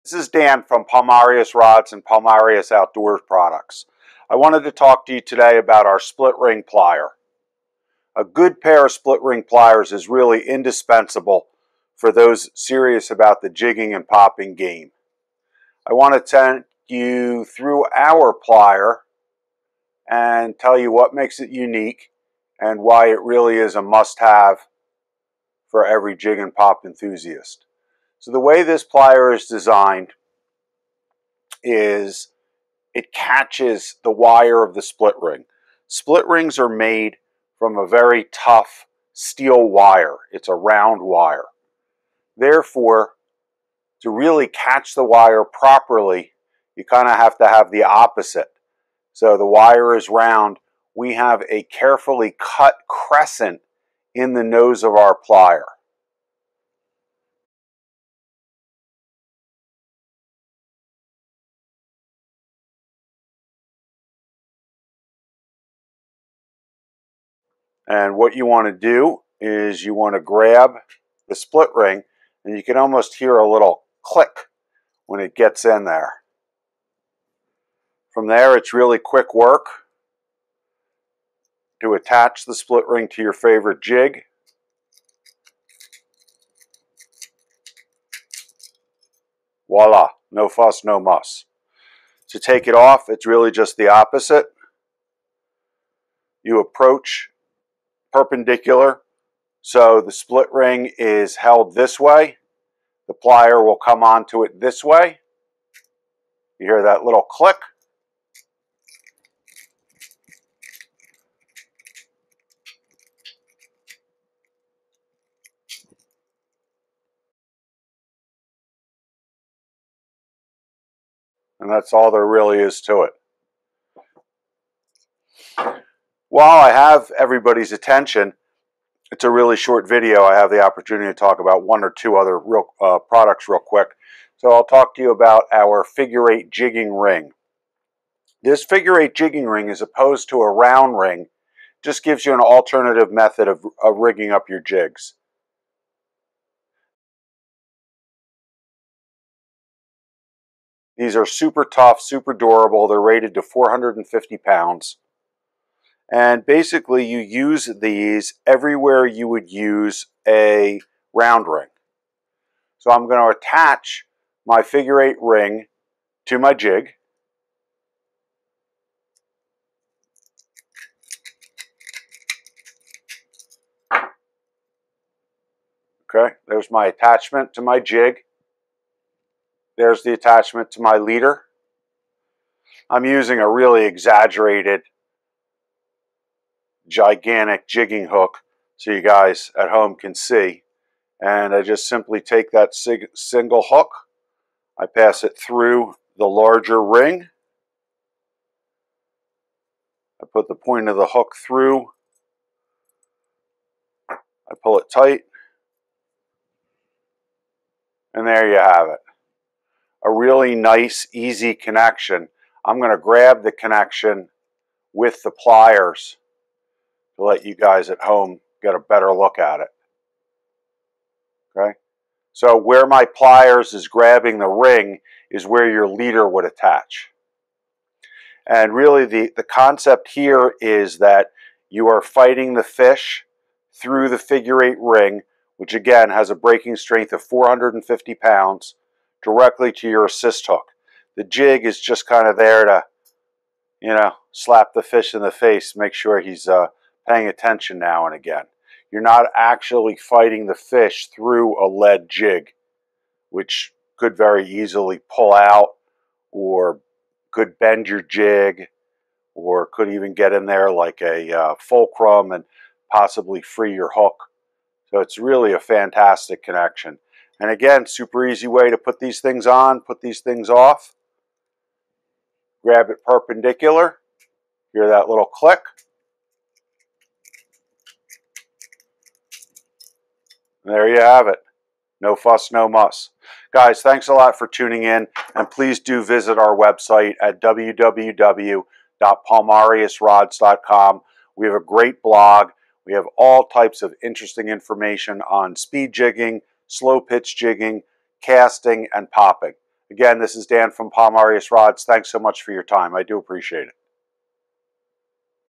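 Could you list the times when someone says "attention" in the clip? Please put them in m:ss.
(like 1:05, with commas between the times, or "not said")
2:07, 4:07.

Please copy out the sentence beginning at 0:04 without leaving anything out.
I wanted to talk to you today about our split ring plier.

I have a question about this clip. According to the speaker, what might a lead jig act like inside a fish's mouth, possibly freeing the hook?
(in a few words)
Fulcrum.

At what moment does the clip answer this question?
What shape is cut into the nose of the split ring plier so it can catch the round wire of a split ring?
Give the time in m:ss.
0:52.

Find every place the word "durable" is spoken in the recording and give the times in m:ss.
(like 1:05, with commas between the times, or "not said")
2:32.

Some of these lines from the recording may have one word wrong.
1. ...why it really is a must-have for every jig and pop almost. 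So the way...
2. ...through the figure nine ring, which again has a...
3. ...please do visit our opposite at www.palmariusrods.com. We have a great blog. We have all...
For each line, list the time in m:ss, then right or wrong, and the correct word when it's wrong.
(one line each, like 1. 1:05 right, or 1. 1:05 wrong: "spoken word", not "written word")
1. 0:22 wrong: "enthusiast", not "almost"
2. 3:53 wrong: "eight", not "nine"
3. 4:45 wrong: "website", not "opposite".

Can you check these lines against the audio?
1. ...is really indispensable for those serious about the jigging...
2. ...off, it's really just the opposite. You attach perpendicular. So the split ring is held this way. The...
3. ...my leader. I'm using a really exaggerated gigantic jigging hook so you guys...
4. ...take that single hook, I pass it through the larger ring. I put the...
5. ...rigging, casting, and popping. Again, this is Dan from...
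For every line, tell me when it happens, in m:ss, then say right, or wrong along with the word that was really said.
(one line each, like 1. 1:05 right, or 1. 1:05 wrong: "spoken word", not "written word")
1. 0:09 right
2. 1:32 wrong: "approach", not "attach"
3. 3:00 right
4. 3:12 right
5. 4:57 wrong: "jigging", not "rigging".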